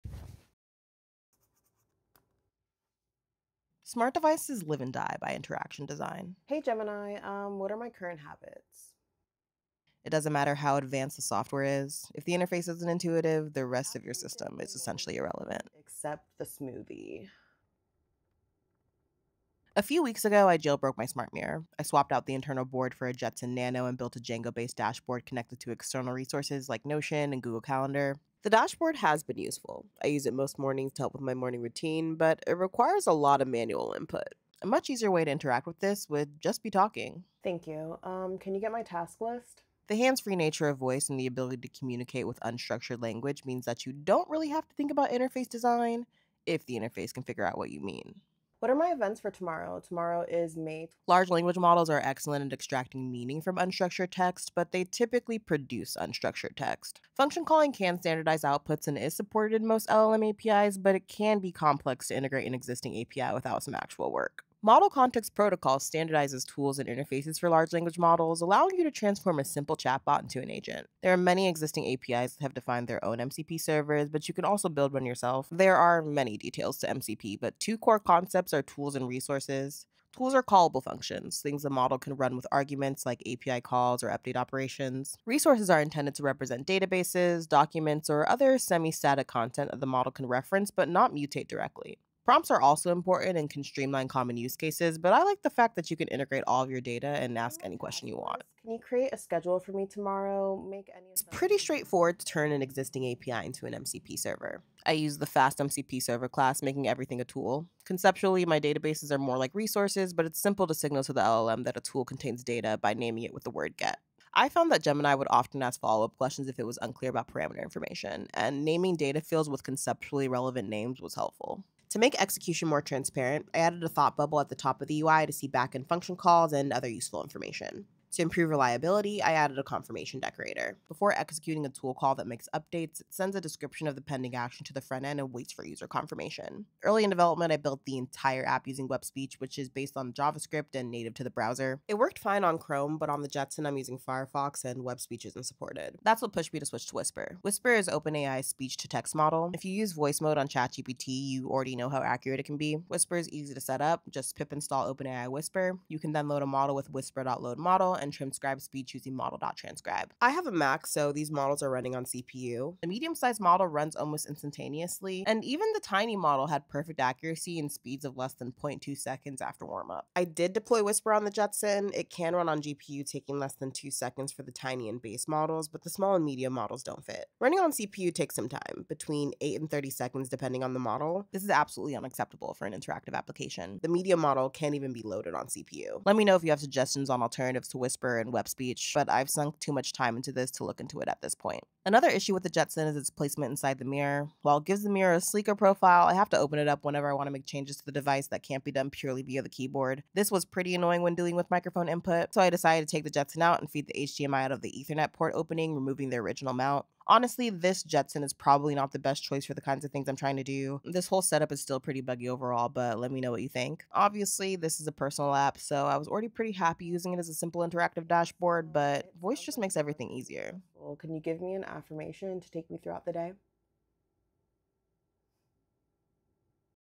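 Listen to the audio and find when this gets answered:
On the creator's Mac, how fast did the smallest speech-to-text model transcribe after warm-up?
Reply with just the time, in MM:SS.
02:48.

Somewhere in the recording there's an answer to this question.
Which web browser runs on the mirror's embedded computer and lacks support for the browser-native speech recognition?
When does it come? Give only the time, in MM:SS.
02:23.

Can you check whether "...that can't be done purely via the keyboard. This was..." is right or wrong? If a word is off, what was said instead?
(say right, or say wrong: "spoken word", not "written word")
right.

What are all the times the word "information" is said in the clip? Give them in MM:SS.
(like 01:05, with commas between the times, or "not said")
01:57, 02:07.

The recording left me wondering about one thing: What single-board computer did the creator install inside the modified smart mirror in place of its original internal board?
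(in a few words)
Jetson Nano.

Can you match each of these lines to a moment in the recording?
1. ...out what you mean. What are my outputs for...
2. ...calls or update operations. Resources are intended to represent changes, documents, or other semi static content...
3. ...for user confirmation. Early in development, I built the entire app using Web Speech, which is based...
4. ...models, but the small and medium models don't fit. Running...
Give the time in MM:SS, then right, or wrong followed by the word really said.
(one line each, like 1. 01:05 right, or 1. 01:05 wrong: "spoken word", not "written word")
1. 00:47 wrong: "events", not "outputs"
2. 01:23 wrong: "databases", not "changes"
3. 02:15 right
4. 02:55 right.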